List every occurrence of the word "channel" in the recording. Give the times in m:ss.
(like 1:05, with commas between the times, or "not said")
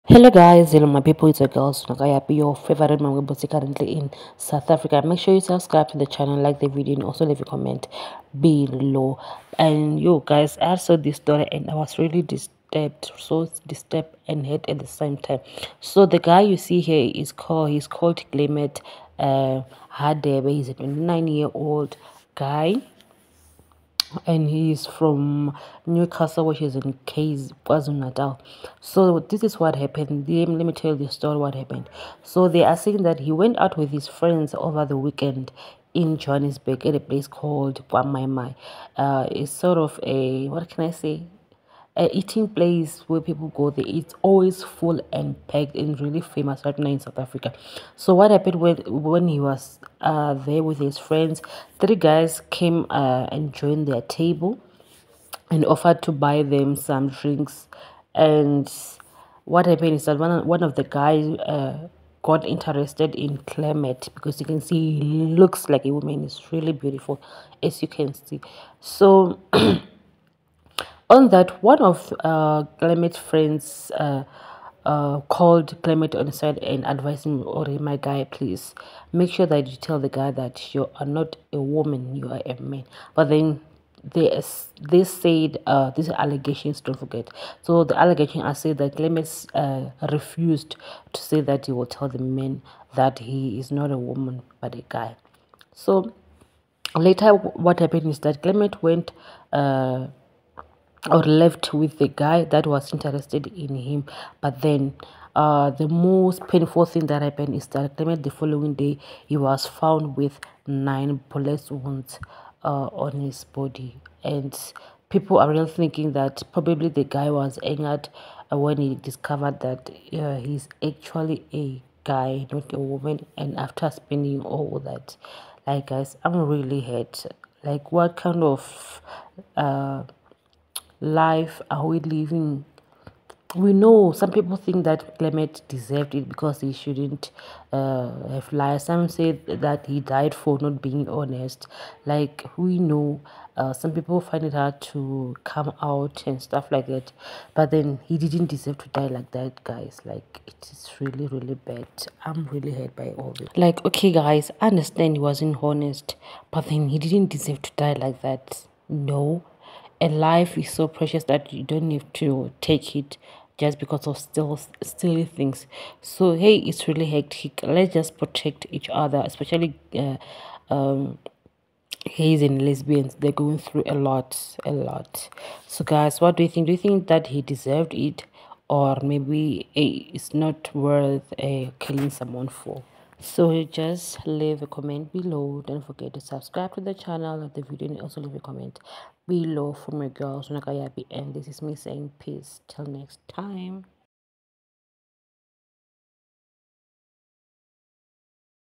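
0:06, 3:06.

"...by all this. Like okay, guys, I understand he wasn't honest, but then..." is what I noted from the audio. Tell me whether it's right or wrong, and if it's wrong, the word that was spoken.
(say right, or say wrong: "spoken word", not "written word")
right.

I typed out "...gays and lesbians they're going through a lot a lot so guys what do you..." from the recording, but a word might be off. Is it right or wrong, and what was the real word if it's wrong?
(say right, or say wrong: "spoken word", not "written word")
right.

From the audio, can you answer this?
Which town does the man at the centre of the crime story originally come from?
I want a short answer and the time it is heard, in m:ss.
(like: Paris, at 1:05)
Newcastle, at 0:25.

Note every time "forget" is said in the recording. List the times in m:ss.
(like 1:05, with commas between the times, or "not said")
1:26, 3:05.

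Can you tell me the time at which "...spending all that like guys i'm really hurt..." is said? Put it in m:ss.
2:03.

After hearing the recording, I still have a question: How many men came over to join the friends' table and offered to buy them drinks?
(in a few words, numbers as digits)
3.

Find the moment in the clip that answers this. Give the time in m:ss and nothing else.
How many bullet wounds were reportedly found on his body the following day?
1:50.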